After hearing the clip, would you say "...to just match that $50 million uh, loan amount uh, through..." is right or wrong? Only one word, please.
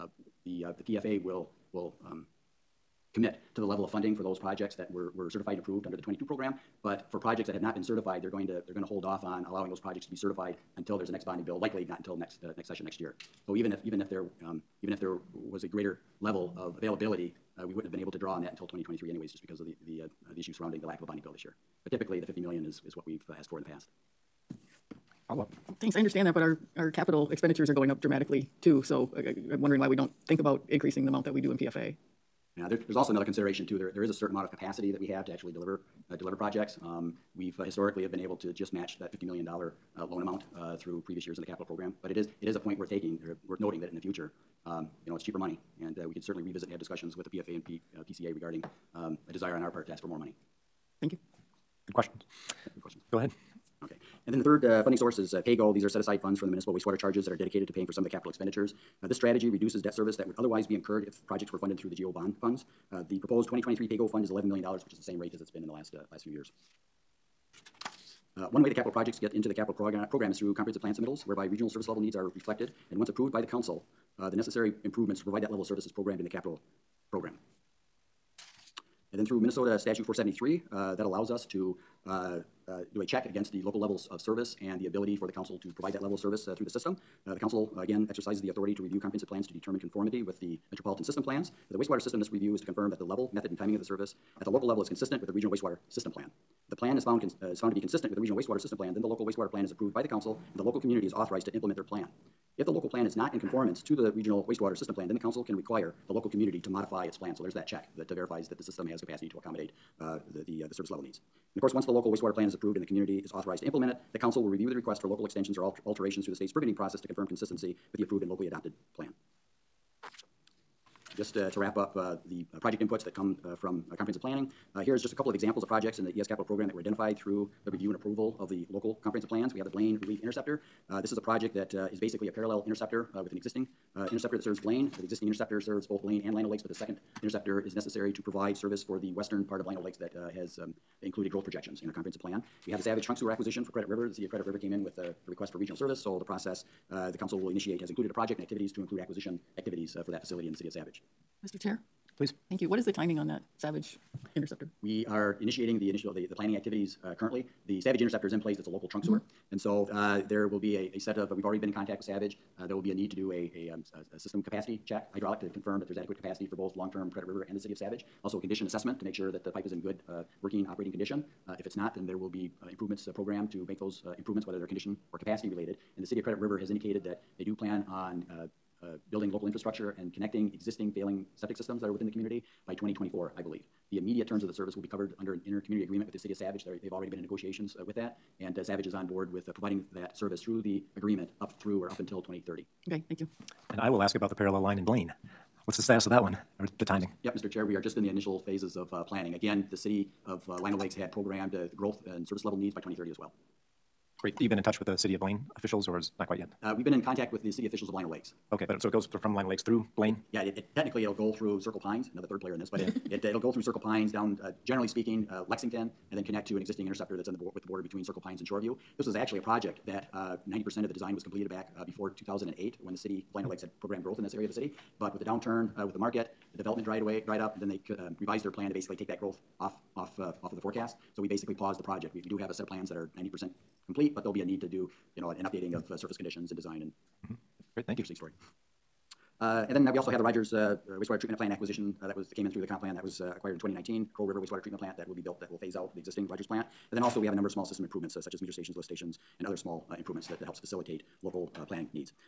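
right.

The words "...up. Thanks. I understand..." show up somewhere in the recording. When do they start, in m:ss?
0:25.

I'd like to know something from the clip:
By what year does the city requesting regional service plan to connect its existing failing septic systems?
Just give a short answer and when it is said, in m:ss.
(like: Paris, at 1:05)
2024, at 3:02.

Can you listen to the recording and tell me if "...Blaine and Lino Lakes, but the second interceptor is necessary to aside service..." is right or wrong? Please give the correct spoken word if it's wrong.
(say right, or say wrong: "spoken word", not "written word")
wrong: "provide", not "aside".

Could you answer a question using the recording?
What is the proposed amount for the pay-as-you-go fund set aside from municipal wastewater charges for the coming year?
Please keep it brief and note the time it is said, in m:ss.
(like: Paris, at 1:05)
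$11 million, at 1:04.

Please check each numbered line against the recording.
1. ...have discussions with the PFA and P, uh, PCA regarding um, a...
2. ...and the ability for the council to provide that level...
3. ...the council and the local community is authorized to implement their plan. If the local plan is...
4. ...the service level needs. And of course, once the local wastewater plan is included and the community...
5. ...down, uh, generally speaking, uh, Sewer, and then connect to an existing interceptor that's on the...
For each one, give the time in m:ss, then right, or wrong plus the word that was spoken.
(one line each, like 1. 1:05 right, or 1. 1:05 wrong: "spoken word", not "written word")
1. 0:46 right
2. 1:24 right
3. 1:40 right
4. 1:50 wrong: "approved", not "included"
5. 3:34 wrong: "Lexington", not "Sewer".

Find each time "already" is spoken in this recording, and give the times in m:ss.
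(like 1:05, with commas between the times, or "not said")
2:41, 3:06.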